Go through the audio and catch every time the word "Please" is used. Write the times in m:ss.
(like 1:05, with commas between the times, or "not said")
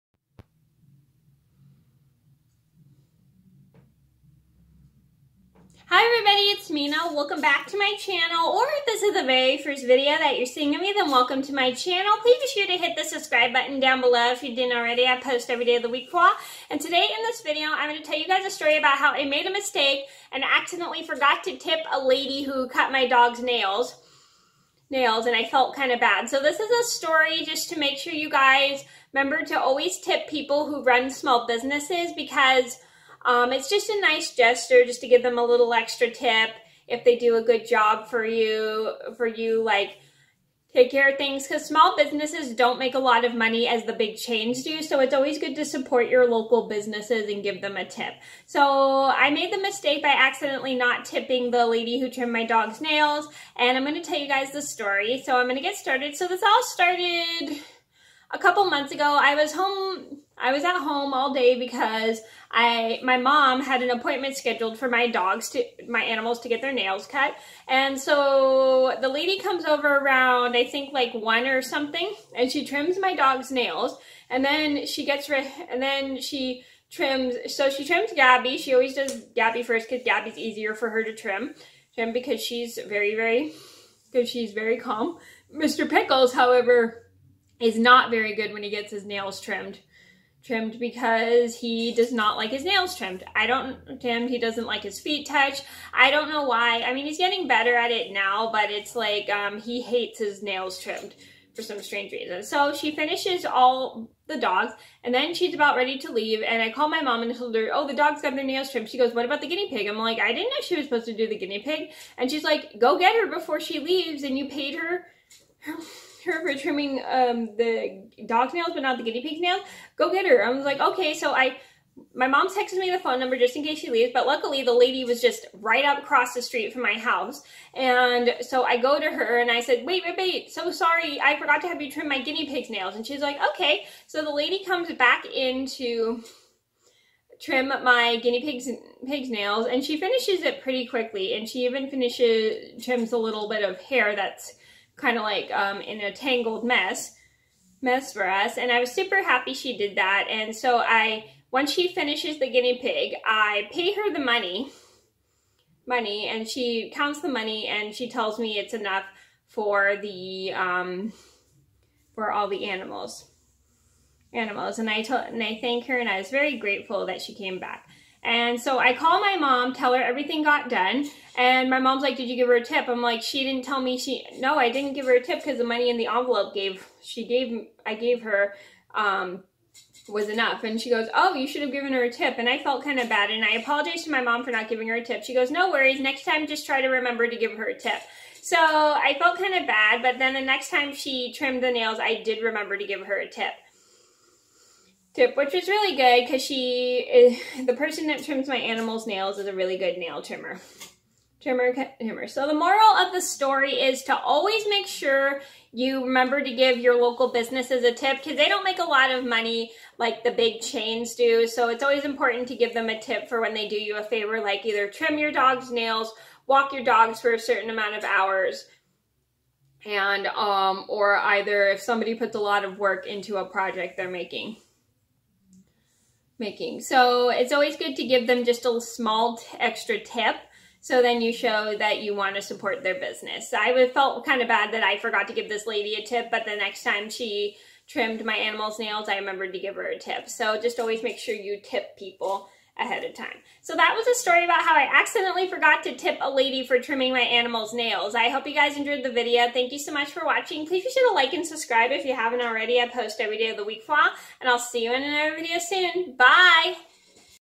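0:12, 4:10.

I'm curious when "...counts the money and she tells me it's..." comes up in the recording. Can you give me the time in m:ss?
2:36.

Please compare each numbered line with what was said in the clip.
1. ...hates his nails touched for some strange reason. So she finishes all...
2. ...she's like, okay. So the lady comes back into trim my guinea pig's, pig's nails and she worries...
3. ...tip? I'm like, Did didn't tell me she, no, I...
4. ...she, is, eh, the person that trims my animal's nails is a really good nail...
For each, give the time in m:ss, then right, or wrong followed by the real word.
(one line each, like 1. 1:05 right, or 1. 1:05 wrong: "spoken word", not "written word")
1. 1:39 wrong: "trimmed", not "touched"
2. 2:13 wrong: "finishes", not "worries"
3. 2:52 wrong: "She", not "Did"
4. 3:16 right.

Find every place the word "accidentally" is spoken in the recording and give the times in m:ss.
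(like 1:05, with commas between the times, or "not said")
0:20, 0:50, 4:04.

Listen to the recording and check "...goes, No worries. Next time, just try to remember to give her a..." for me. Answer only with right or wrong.
right.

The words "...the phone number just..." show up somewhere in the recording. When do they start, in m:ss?
2:02.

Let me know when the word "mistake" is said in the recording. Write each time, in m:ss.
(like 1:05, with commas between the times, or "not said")
0:19, 0:49.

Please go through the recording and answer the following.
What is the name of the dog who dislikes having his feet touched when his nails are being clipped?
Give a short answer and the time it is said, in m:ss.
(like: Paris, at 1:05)
Mr. Pickles, at 1:25.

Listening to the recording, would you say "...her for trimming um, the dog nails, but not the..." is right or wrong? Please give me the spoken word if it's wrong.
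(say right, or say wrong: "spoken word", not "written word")
right.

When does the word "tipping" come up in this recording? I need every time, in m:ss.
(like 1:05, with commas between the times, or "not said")
0:51.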